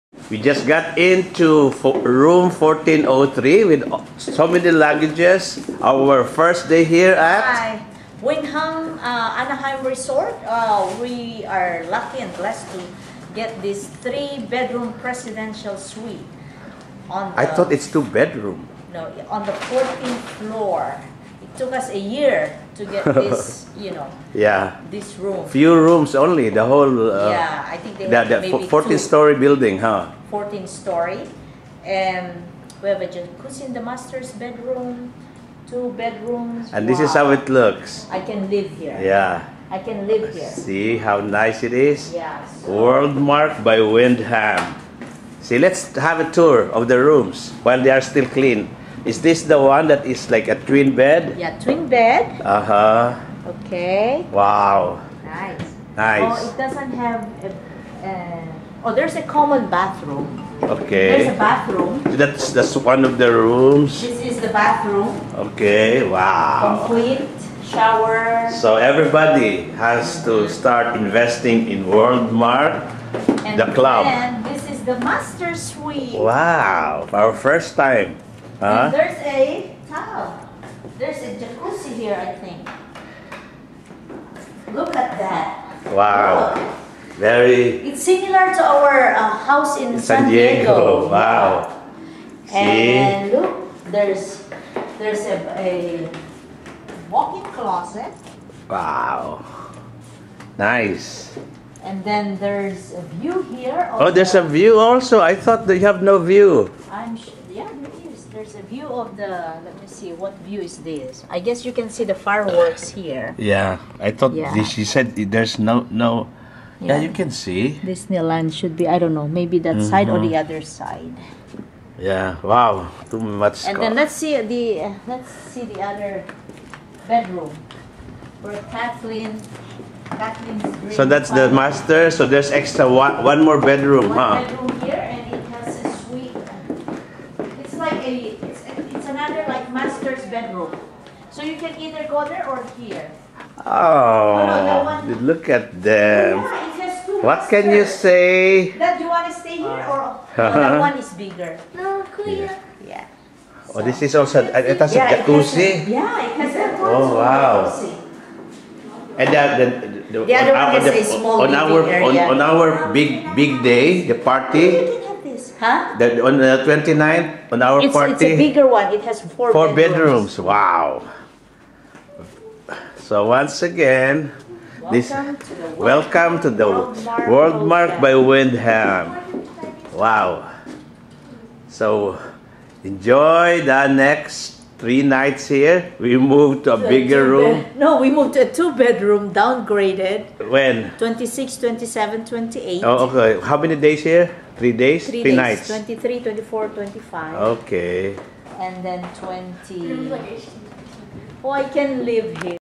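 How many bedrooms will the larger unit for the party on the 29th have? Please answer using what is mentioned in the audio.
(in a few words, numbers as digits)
4.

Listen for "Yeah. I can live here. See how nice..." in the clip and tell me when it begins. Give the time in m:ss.
0:39.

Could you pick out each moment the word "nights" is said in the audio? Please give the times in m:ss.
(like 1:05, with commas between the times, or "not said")
3:05, 3:15.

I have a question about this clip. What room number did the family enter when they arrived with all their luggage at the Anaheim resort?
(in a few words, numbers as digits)
1403.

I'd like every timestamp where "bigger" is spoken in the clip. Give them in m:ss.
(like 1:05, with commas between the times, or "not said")
2:31, 2:48, 3:06.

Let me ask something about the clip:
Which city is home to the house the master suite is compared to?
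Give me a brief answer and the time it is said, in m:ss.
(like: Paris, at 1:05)
San Diego, at 1:29.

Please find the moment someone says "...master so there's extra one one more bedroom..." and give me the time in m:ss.
2:11.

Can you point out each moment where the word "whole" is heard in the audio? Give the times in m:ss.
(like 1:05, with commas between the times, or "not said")
0:26.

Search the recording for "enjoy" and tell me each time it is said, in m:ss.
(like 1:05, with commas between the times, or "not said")
3:02.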